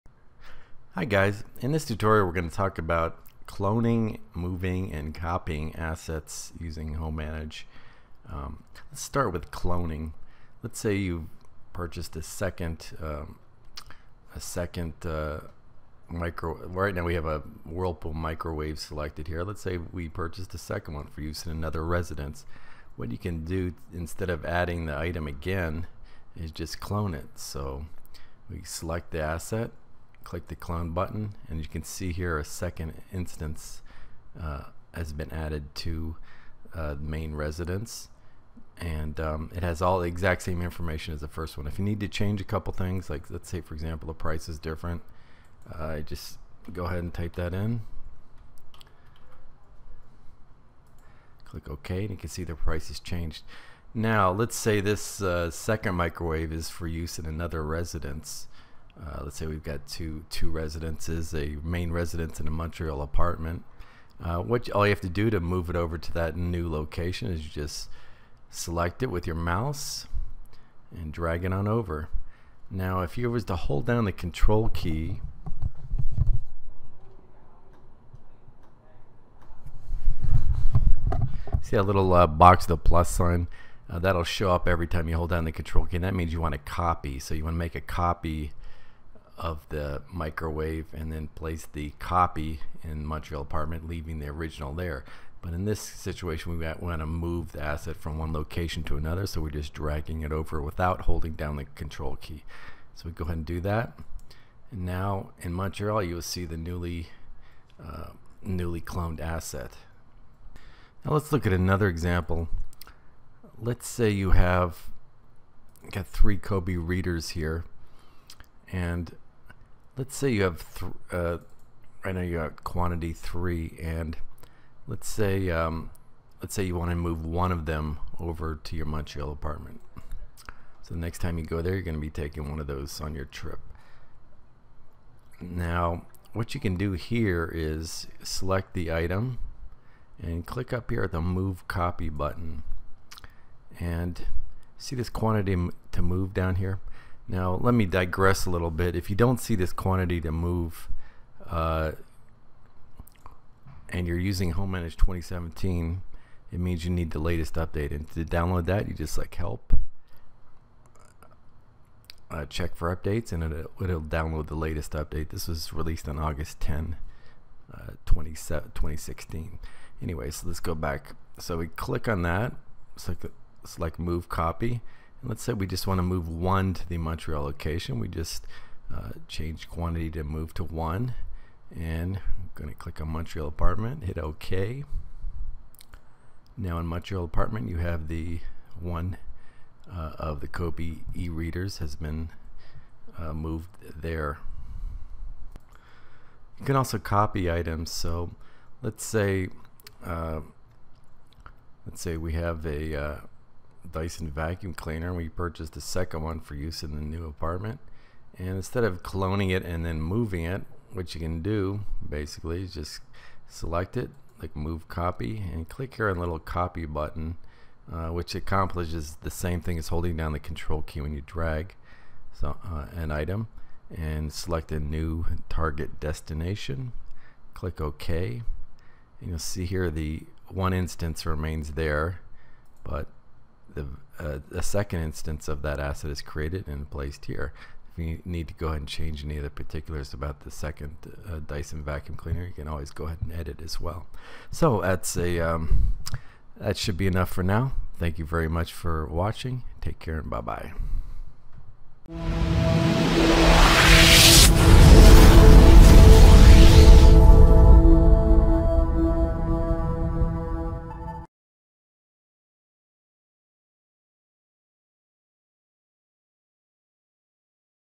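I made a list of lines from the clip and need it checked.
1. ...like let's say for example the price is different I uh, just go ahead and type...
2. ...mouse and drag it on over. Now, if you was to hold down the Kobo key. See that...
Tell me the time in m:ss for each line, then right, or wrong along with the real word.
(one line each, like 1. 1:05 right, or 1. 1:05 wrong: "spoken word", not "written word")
1. 0:43 right
2. 1:09 wrong: "Control", not "Kobo".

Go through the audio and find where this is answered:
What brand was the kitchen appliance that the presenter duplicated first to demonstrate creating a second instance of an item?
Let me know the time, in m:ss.
0:17.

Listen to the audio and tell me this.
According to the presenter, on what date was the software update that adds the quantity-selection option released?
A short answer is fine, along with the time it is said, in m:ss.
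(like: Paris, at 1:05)
August 10, 2016, at 2:46.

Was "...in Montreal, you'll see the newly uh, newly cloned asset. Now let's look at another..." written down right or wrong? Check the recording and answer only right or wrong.
right.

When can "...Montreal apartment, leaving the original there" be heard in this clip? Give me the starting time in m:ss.
1:33.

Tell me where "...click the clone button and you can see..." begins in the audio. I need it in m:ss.
0:30.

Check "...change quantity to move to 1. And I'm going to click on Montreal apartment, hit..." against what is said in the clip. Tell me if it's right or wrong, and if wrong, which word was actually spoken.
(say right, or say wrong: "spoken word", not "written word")
right.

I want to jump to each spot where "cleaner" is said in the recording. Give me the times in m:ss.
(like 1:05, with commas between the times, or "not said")
3:24, 4:02.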